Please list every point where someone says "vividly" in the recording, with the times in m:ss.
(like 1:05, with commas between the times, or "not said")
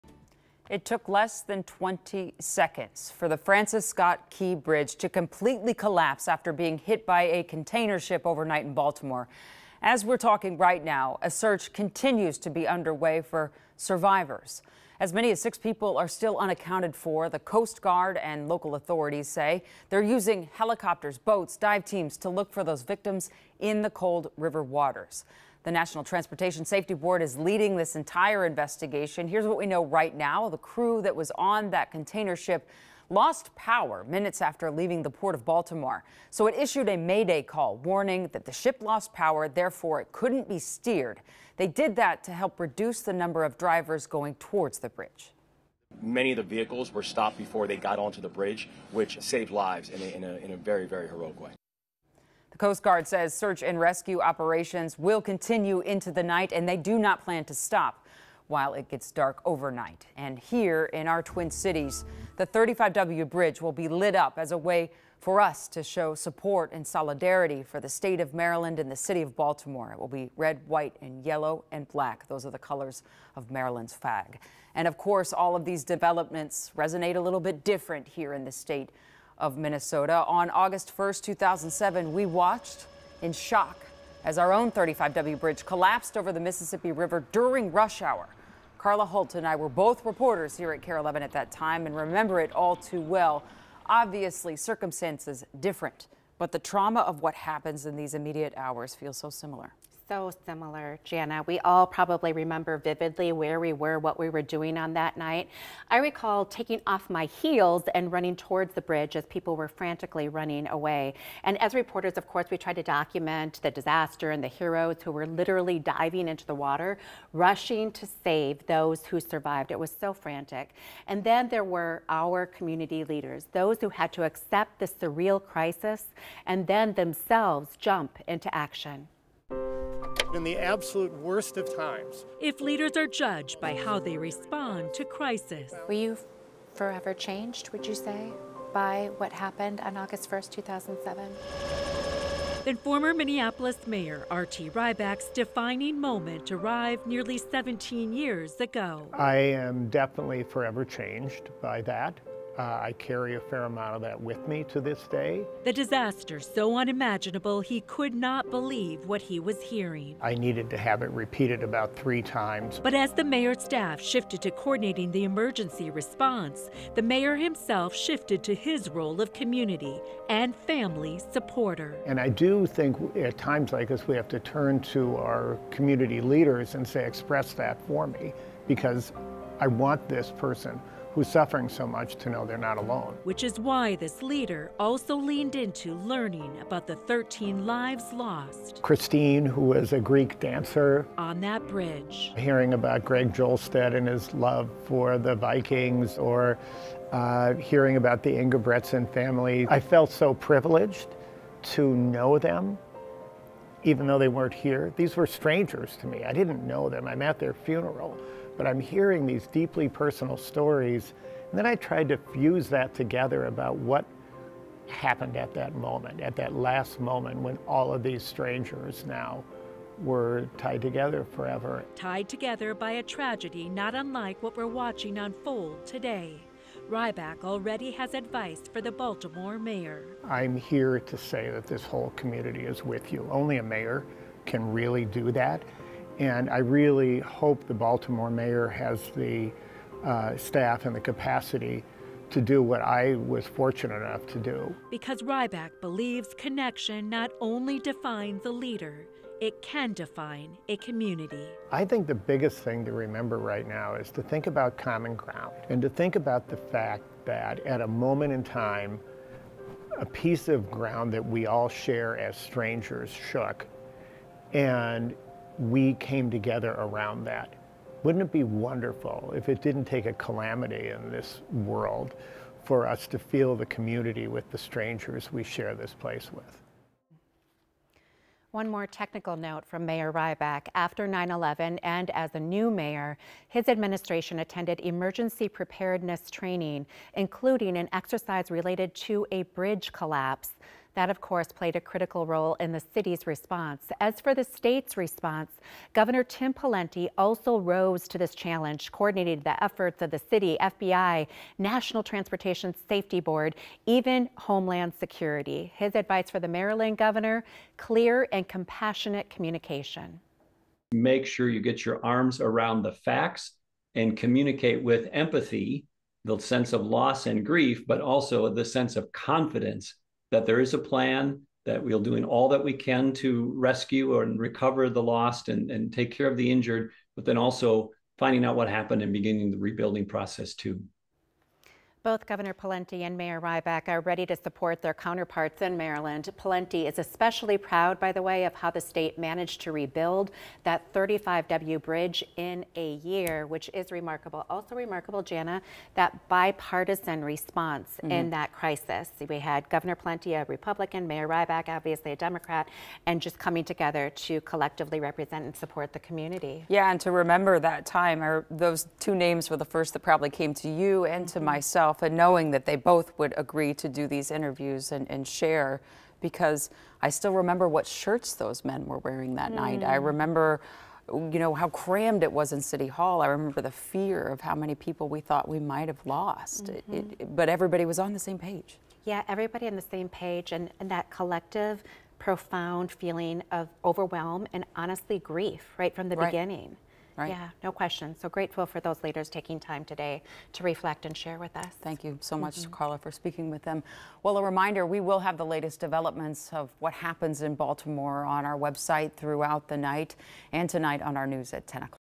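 1:42.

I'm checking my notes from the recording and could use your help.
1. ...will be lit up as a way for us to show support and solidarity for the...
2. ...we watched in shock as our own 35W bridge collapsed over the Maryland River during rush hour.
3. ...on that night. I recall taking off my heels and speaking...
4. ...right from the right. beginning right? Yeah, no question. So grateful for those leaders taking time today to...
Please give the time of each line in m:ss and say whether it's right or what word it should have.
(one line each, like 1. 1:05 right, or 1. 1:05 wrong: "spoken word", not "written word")
1. 1:03 right
2. 1:22 wrong: "Mississippi", not "Maryland"
3. 1:44 wrong: "running", not "speaking"
4. 6:25 right.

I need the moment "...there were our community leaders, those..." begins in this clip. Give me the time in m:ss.
2:01.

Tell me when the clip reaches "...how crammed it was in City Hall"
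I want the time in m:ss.
6:11.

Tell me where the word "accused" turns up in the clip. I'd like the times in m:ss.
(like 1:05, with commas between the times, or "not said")
not said.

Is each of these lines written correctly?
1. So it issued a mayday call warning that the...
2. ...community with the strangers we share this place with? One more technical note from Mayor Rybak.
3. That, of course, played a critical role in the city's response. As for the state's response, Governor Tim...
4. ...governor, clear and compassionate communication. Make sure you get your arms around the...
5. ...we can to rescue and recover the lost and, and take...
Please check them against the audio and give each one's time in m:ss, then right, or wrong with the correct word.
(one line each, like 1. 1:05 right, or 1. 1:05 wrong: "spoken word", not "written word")
1. 0:36 right
2. 4:33 right
3. 4:50 right
4. 5:06 right
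5. 5:22 right.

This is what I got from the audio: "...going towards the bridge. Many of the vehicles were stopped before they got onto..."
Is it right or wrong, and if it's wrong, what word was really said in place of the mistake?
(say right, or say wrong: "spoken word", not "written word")
right.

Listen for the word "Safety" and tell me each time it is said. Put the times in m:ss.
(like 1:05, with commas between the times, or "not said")
0:26, 5:02.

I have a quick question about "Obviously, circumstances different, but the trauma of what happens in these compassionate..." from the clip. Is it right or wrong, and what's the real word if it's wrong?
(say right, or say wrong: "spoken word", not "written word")
wrong: "immediate", not "compassionate".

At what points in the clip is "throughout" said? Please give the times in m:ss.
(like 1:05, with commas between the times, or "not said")
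6:39.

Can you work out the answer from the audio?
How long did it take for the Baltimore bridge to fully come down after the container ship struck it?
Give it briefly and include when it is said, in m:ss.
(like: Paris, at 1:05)
less than 20 seconds, at 0:01.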